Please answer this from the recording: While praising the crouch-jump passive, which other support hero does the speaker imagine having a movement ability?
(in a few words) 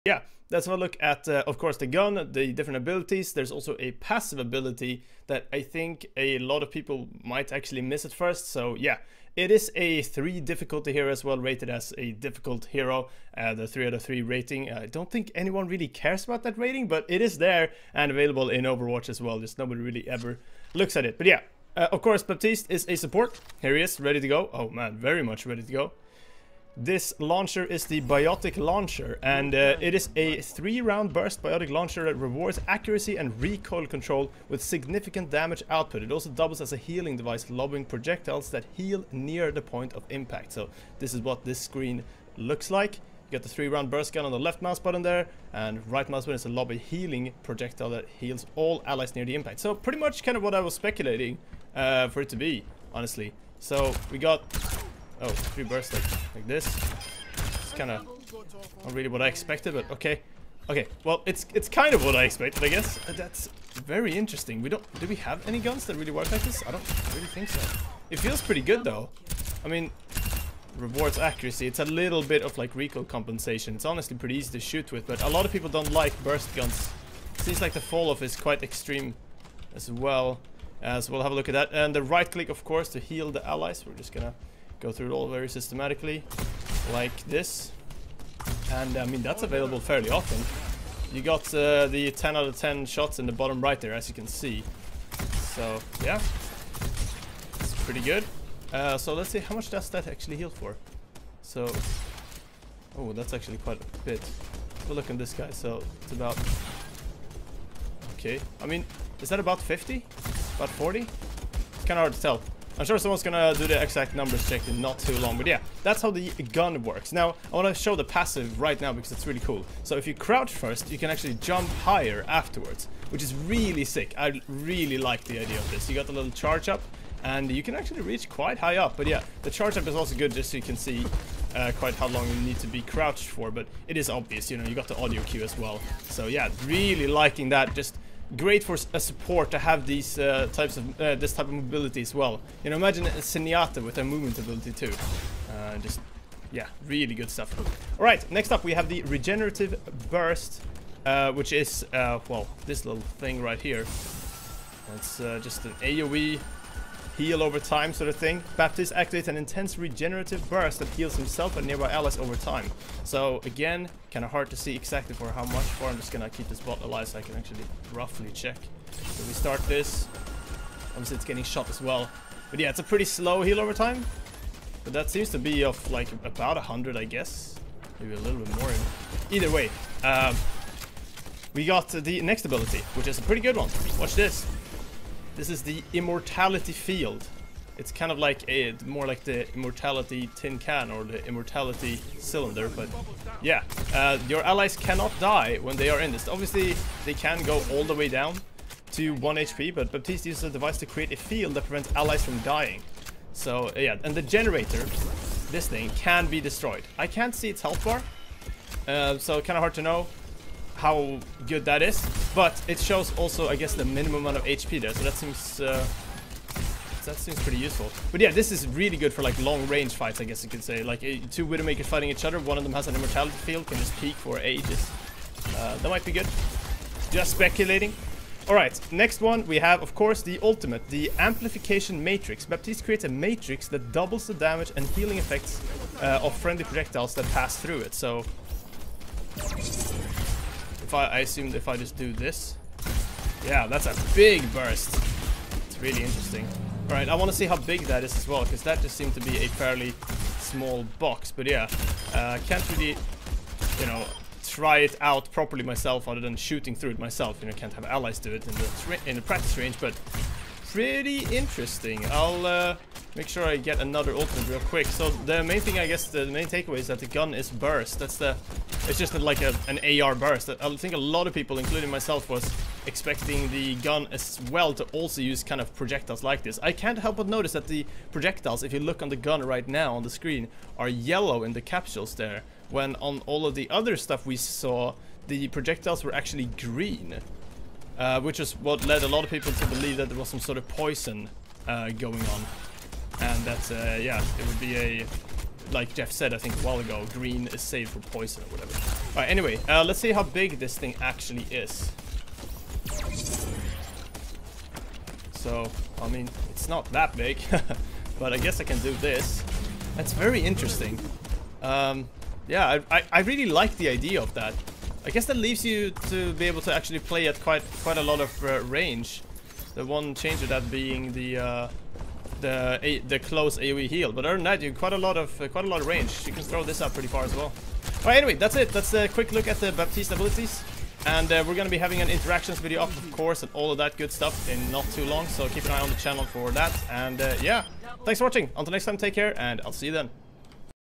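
Zenyatta.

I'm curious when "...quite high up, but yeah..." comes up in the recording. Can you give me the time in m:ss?
2:08.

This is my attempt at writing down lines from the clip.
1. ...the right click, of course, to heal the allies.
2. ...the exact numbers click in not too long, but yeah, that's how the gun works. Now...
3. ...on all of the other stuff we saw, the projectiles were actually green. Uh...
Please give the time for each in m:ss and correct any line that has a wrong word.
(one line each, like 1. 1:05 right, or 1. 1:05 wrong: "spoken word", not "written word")
1. 1:21 right
2. 1:53 wrong: "check", not "click"
3. 4:42 right.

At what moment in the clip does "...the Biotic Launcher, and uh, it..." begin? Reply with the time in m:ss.
0:27.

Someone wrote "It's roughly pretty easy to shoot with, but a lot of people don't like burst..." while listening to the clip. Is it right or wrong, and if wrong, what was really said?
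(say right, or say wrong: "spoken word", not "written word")
wrong: "honestly", not "roughly".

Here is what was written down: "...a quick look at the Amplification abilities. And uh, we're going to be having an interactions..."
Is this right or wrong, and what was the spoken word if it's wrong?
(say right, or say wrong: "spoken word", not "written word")
wrong: "Baptiste", not "Amplification".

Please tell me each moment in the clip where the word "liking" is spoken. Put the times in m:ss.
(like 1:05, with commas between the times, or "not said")
2:17.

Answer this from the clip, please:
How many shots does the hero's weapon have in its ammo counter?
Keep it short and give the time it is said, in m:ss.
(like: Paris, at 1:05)
10, at 1:32.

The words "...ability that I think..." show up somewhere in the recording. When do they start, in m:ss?
0:04.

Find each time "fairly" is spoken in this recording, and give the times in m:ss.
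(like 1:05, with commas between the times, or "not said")
1:29, 4:09.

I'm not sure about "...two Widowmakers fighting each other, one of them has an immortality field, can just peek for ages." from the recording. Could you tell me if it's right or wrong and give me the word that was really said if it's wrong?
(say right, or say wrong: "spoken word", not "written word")
right.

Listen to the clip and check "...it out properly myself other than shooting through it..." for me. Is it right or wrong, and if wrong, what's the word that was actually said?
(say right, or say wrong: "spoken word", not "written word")
right.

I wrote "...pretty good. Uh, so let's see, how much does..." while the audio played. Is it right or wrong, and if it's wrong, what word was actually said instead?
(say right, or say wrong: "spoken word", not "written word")
right.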